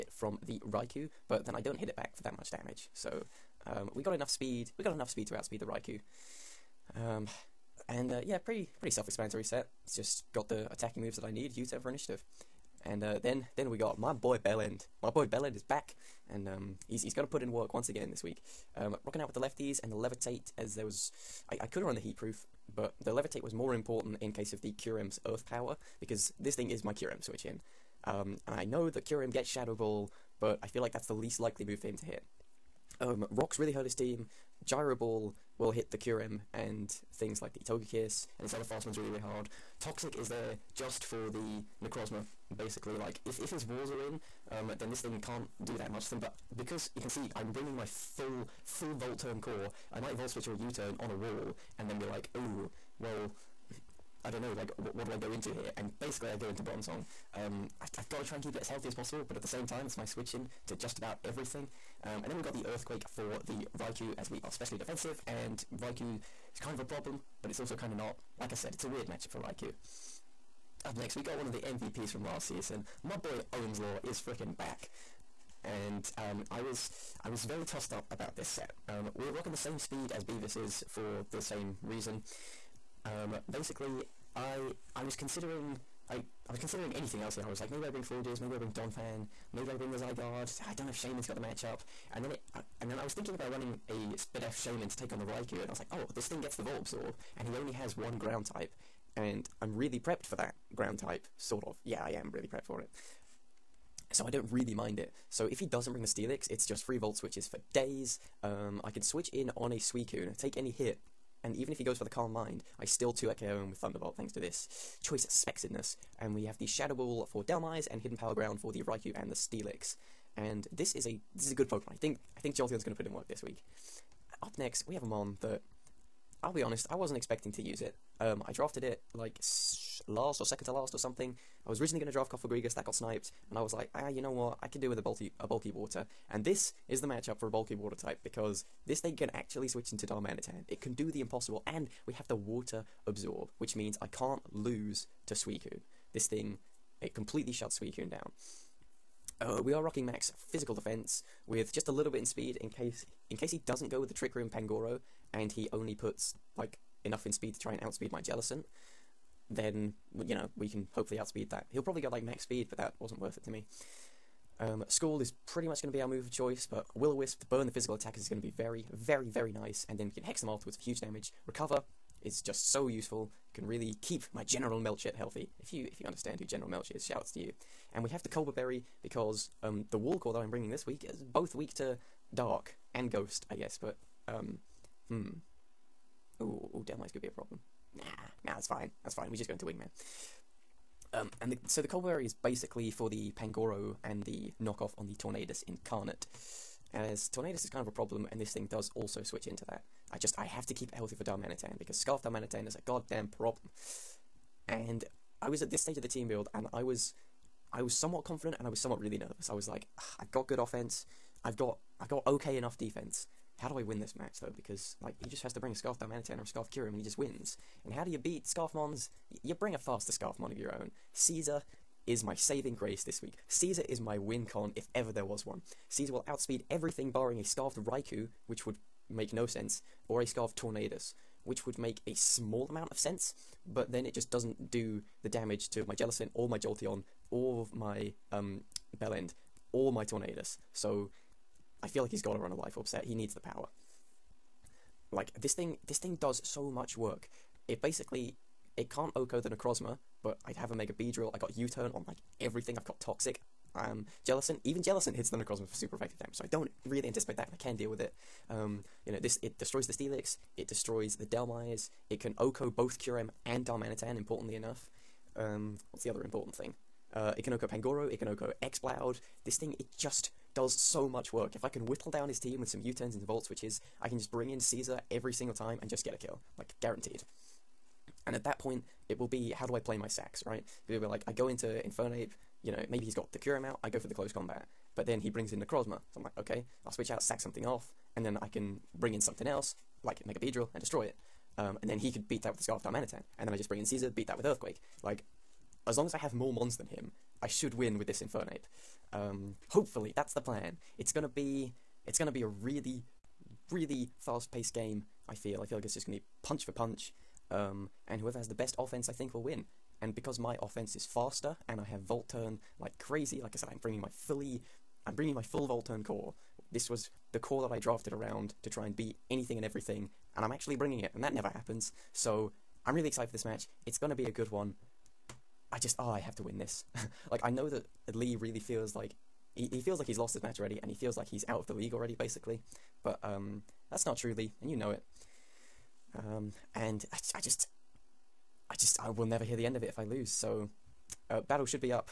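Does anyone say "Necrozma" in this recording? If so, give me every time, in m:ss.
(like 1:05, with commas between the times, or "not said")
0:41, 4:09, 4:45.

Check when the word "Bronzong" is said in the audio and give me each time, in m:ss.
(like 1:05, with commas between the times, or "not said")
0:56.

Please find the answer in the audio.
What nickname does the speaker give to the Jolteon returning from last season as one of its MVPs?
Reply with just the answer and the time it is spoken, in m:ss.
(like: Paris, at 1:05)
Ohm's Law, at 1:13.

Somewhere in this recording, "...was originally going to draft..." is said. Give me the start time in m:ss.
2:11.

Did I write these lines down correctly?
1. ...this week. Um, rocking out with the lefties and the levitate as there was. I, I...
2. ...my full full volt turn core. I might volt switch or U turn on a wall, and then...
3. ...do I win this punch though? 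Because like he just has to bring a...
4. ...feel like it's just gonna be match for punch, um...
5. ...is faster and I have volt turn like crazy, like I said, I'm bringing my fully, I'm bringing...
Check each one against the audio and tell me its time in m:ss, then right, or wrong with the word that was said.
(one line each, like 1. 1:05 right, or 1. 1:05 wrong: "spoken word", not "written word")
1. 0:18 right
2. 0:47 right
3. 3:33 wrong: "match", not "punch"
4. 5:05 wrong: "punch", not "match"
5. 5:10 right.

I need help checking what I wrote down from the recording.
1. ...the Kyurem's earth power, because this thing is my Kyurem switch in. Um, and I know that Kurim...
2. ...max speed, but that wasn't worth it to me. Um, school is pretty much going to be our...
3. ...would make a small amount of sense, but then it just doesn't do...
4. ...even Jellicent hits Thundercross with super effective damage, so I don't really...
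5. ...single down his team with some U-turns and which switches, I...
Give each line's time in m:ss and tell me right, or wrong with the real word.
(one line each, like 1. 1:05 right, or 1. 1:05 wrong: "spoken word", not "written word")
1. 0:24 right
2. 2:42 right
3. 3:51 right
4. 4:14 right
5. 4:31 wrong: "whittle", not "single".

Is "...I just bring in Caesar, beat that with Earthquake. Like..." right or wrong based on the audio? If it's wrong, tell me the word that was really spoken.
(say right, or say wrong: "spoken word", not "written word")
right.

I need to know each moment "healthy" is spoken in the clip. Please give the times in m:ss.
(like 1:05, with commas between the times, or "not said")
0:58, 2:55, 3:20.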